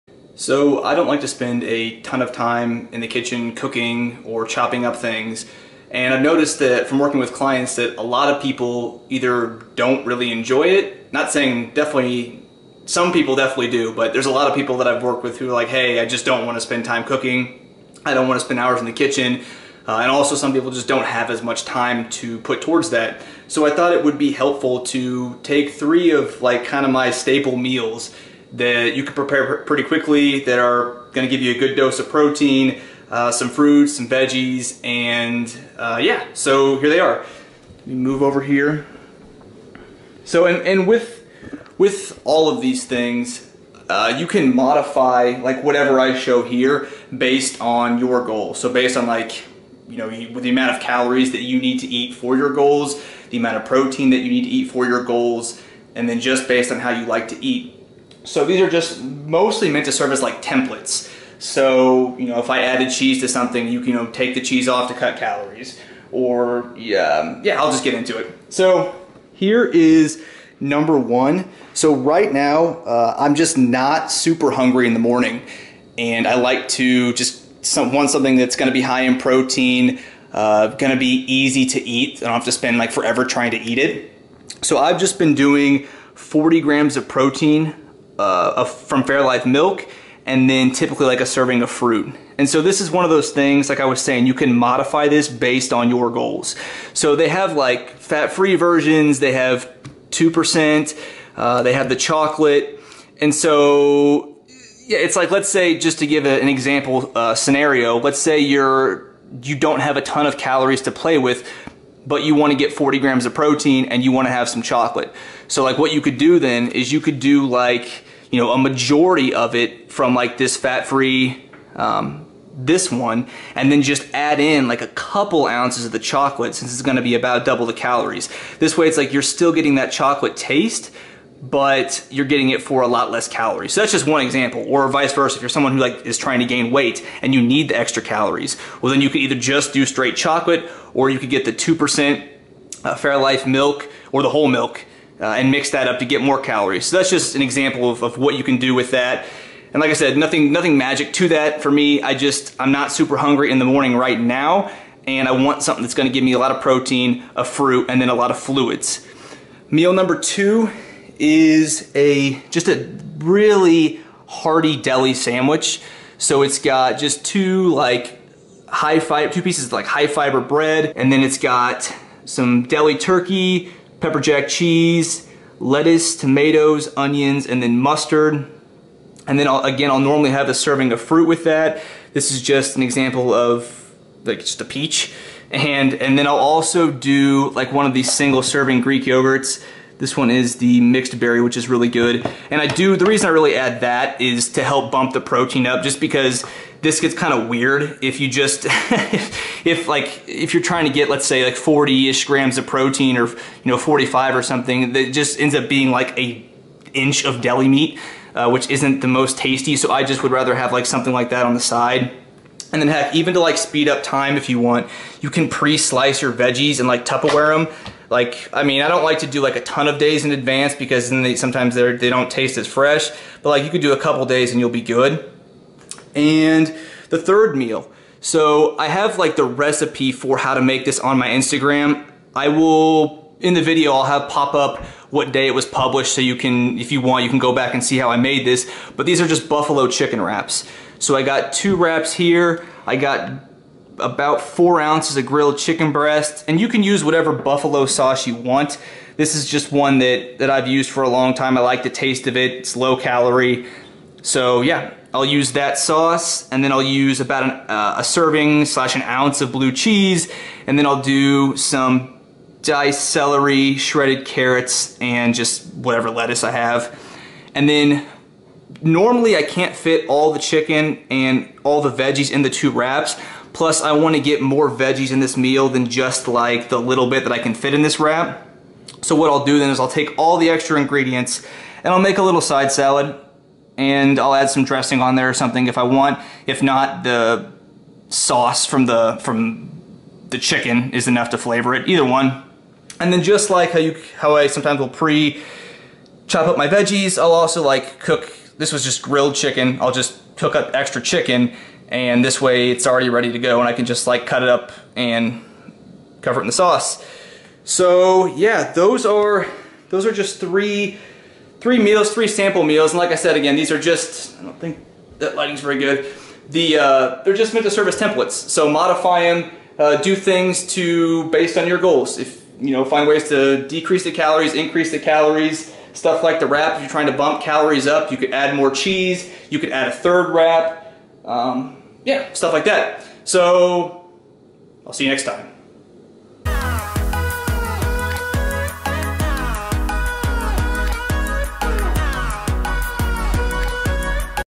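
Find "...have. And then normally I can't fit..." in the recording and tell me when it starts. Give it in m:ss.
4:26.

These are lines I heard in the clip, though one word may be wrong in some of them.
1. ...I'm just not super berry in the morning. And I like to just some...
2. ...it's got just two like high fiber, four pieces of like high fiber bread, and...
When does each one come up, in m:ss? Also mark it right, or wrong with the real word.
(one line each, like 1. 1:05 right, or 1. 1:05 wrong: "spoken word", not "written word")
1. 1:13 wrong: "hungry", not "berry"
2. 2:46 wrong: "two", not "four".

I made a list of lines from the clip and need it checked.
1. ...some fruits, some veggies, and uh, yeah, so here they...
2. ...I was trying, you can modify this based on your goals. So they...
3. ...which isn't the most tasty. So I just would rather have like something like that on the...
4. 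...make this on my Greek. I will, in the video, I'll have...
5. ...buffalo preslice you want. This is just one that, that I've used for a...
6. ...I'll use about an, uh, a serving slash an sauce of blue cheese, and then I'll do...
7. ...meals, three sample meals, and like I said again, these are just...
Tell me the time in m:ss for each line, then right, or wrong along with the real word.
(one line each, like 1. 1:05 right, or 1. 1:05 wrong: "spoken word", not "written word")
1. 0:33 right
2. 1:33 wrong: "saying", not "trying"
3. 3:28 right
4. 3:50 wrong: "Instagram", not "Greek"
5. 4:07 wrong: "sauce", not "preslice"
6. 4:16 wrong: "ounce", not "sauce"
7. 5:11 right.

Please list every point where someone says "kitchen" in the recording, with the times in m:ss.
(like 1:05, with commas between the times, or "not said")
0:03, 0:18.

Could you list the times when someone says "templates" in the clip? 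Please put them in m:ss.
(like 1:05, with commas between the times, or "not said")
1:00, 5:17.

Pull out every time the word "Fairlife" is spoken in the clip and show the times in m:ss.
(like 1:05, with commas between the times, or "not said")
1:29, 2:22.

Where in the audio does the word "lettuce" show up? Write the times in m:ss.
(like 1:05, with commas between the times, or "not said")
2:55, 4:26.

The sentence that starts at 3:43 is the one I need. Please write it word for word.
But like you could do a couple days and you'll be good.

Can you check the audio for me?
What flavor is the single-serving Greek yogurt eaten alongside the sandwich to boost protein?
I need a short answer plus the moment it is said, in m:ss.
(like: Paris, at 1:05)
mixed berry, at 3:10.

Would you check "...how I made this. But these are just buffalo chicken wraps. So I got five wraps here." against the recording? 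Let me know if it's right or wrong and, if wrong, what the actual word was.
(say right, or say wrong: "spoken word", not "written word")
wrong: "two", not "five".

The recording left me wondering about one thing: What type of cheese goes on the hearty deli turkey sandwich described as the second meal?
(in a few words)
pepper jack.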